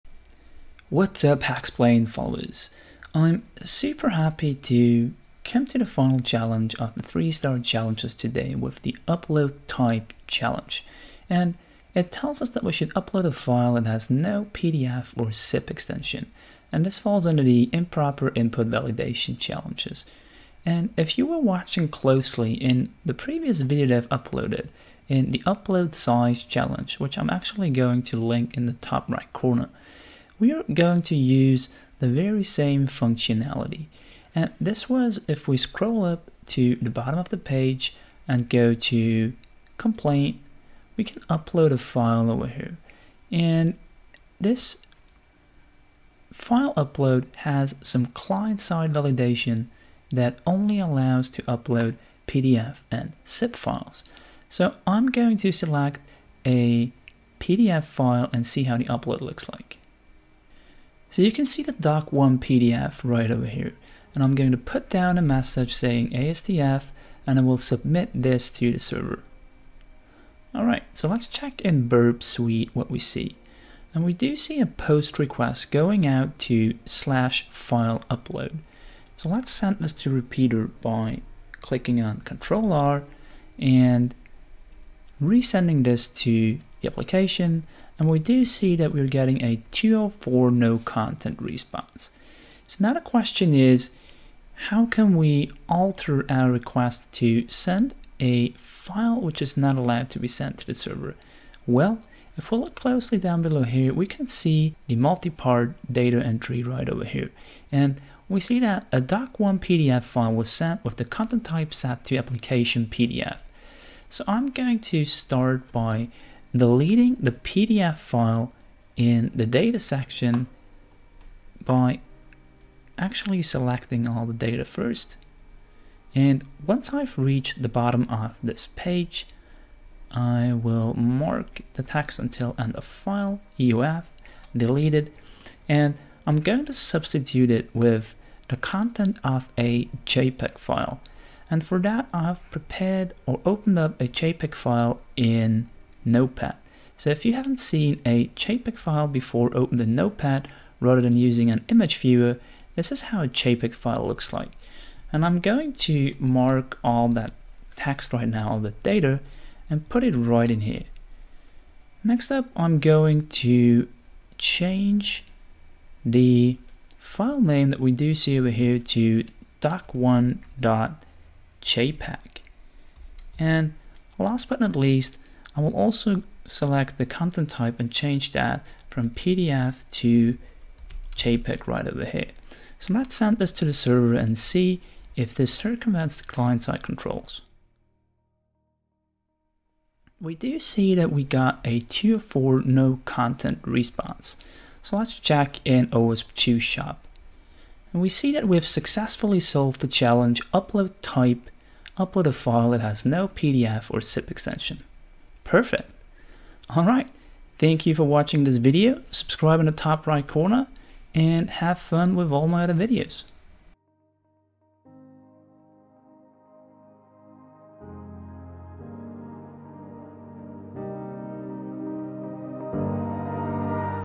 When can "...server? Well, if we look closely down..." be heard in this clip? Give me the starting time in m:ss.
1:40.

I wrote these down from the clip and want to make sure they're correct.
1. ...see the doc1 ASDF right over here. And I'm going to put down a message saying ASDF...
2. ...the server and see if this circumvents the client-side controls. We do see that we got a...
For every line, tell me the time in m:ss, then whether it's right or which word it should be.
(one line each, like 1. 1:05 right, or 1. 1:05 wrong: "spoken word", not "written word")
1. 1:01 wrong: "PDF", not "ASDF"
2. 3:03 right.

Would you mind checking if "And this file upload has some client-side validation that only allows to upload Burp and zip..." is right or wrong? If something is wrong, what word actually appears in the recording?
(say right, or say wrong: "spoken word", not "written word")
wrong: "PDF", not "Burp".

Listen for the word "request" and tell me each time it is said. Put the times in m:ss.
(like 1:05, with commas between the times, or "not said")
1:15, 1:36.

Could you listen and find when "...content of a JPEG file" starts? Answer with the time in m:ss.
2:18.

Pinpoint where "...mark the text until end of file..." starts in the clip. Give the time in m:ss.
2:10.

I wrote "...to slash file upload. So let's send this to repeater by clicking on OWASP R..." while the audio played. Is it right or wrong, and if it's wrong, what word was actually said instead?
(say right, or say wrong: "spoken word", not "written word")
wrong: "Control", not "OWASP".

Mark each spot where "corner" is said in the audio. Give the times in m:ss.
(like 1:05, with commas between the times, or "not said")
0:29, 3:30.